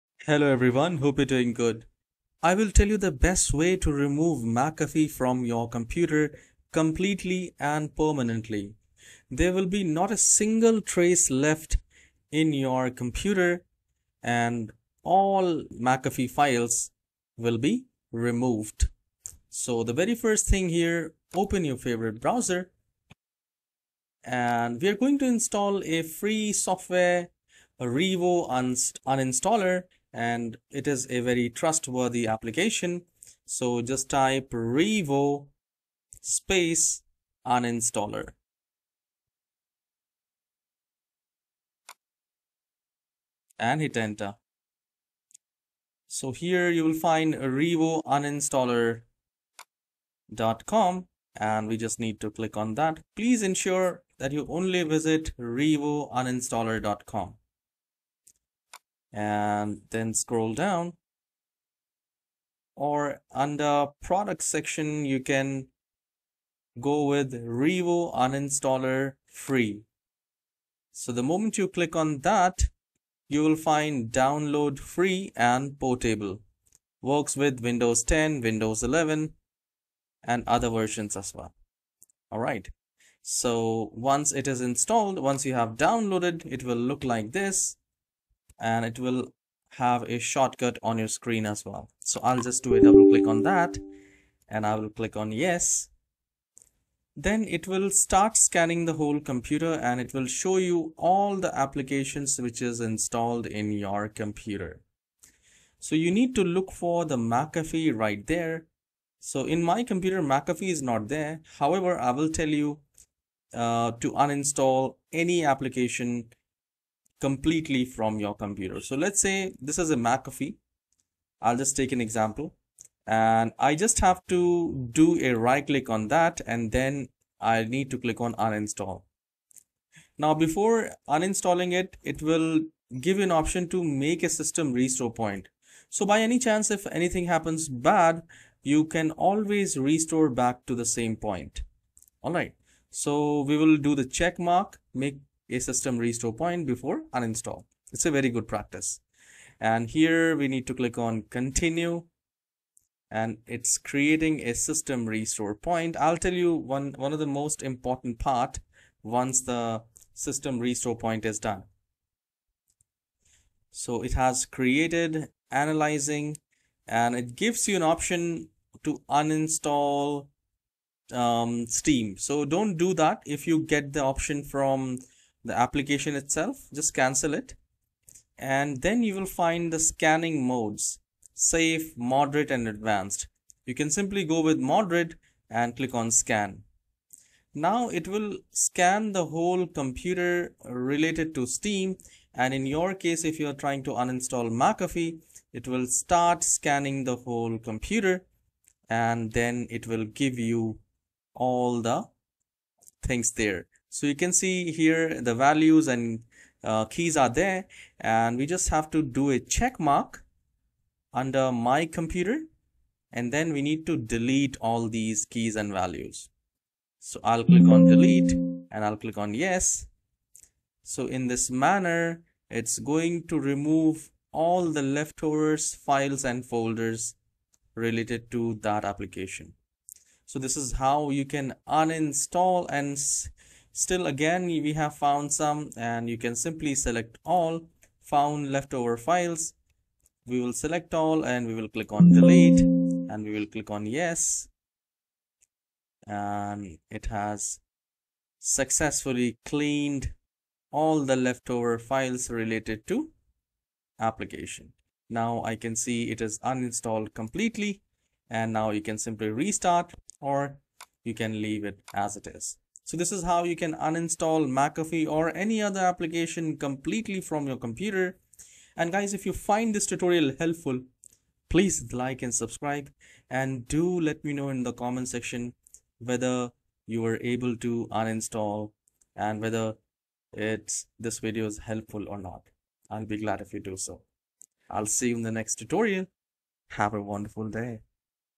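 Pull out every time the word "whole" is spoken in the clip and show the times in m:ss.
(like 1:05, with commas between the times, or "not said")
1:38, 3:09, 3:17.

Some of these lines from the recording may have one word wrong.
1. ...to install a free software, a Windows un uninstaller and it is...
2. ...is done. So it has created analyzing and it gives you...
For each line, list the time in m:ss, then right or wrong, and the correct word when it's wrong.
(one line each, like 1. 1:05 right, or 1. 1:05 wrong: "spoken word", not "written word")
1. 0:25 wrong: "Revo", not "Windows"
2. 2:41 right.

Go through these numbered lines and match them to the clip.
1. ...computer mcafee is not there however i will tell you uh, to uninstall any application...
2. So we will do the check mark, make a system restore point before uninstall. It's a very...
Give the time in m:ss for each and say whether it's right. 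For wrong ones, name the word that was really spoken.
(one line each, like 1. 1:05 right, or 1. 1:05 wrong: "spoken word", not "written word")
1. 1:49 right
2. 2:22 right.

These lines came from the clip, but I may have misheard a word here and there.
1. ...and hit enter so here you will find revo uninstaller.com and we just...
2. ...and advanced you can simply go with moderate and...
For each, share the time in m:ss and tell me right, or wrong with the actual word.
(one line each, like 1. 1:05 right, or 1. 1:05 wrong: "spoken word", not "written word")
1. 0:43 right
2. 3:02 right.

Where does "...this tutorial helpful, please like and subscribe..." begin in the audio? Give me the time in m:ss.
4:29.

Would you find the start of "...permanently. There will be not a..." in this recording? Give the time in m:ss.
0:07.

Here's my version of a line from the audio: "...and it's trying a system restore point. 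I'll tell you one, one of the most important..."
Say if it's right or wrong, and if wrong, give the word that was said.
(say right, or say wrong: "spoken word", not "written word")
wrong: "creating", not "trying".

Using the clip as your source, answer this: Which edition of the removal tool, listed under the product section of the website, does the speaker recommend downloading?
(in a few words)
Revo Uninstaller Free.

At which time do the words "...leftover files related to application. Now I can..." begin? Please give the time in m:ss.
4:11.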